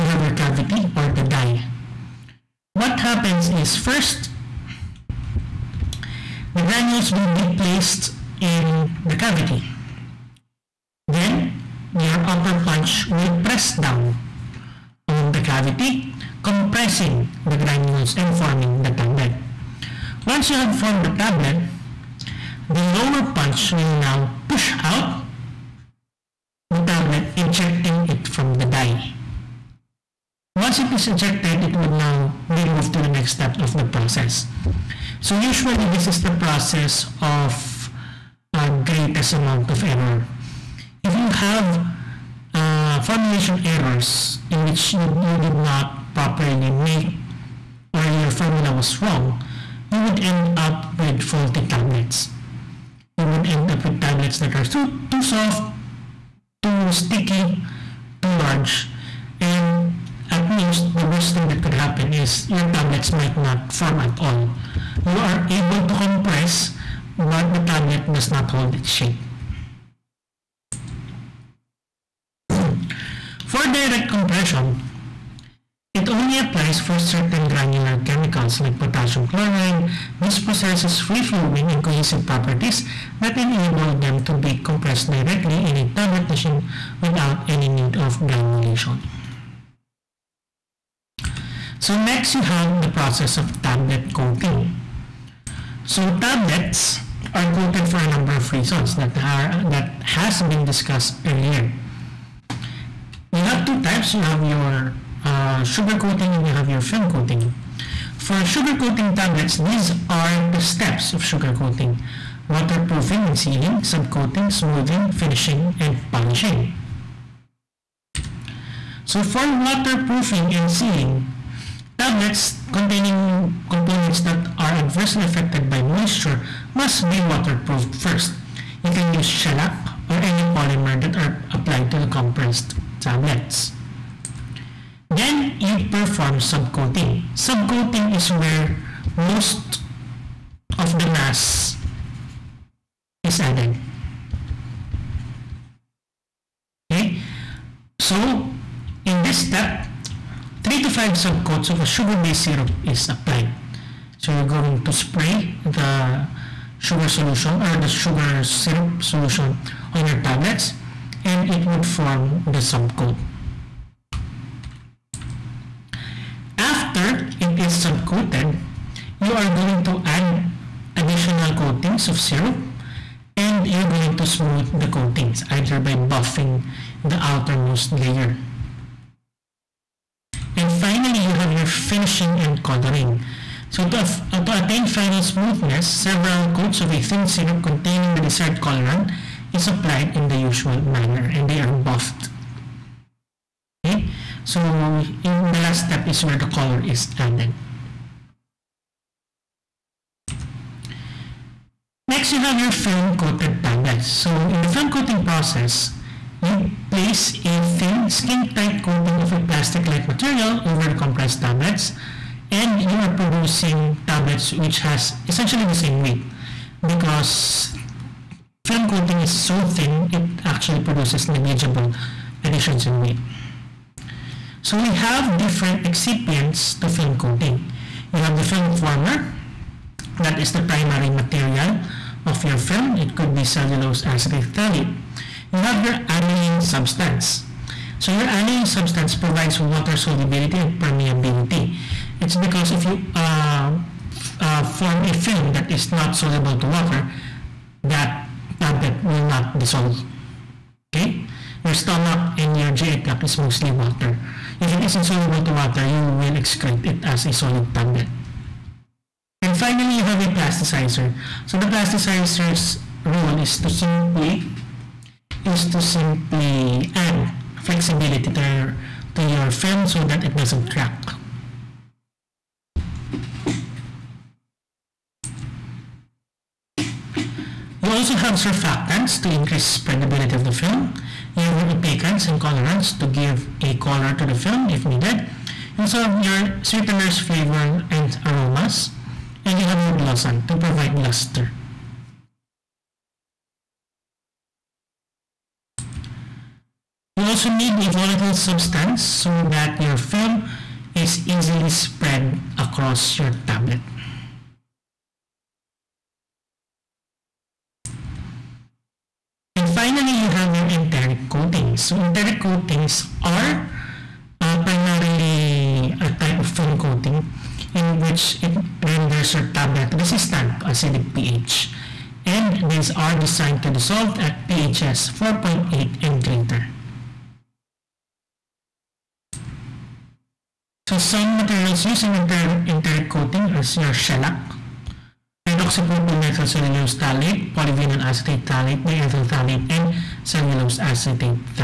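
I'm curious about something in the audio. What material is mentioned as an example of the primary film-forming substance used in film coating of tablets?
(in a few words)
cellulose acetate phthalate.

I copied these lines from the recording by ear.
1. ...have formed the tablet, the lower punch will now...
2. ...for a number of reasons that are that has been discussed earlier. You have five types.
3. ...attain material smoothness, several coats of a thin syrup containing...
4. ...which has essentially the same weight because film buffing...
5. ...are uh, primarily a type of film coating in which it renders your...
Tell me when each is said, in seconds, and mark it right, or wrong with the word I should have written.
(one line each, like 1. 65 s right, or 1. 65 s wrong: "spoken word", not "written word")
1. 20 s right
2. 97 s wrong: "two", not "five"
3. 184 s wrong: "final", not "material"
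4. 214 s wrong: "coating", not "buffing"
5. 313 s right.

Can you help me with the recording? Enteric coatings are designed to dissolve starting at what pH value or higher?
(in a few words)
4.8.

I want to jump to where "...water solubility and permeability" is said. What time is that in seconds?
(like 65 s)
239 s.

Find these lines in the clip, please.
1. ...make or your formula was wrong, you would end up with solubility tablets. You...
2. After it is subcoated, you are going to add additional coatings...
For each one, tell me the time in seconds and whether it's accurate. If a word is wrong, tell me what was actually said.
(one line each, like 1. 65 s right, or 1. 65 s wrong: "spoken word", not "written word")
1. 46 s wrong: "faulty", not "solubility"
2. 166 s right.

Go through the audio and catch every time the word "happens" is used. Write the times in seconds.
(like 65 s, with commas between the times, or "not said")
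3 s, 61 s.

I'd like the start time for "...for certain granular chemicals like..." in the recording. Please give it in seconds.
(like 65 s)
76 s.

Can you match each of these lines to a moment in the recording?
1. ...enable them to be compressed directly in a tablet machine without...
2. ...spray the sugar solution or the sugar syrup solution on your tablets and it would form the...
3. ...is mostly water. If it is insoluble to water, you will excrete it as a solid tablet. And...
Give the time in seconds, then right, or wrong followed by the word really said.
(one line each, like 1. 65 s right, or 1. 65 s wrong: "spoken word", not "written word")
1. 83 s right
2. 154 s right
3. 253 s right.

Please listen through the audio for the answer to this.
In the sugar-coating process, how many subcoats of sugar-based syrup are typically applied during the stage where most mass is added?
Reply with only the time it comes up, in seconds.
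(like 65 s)
150 s.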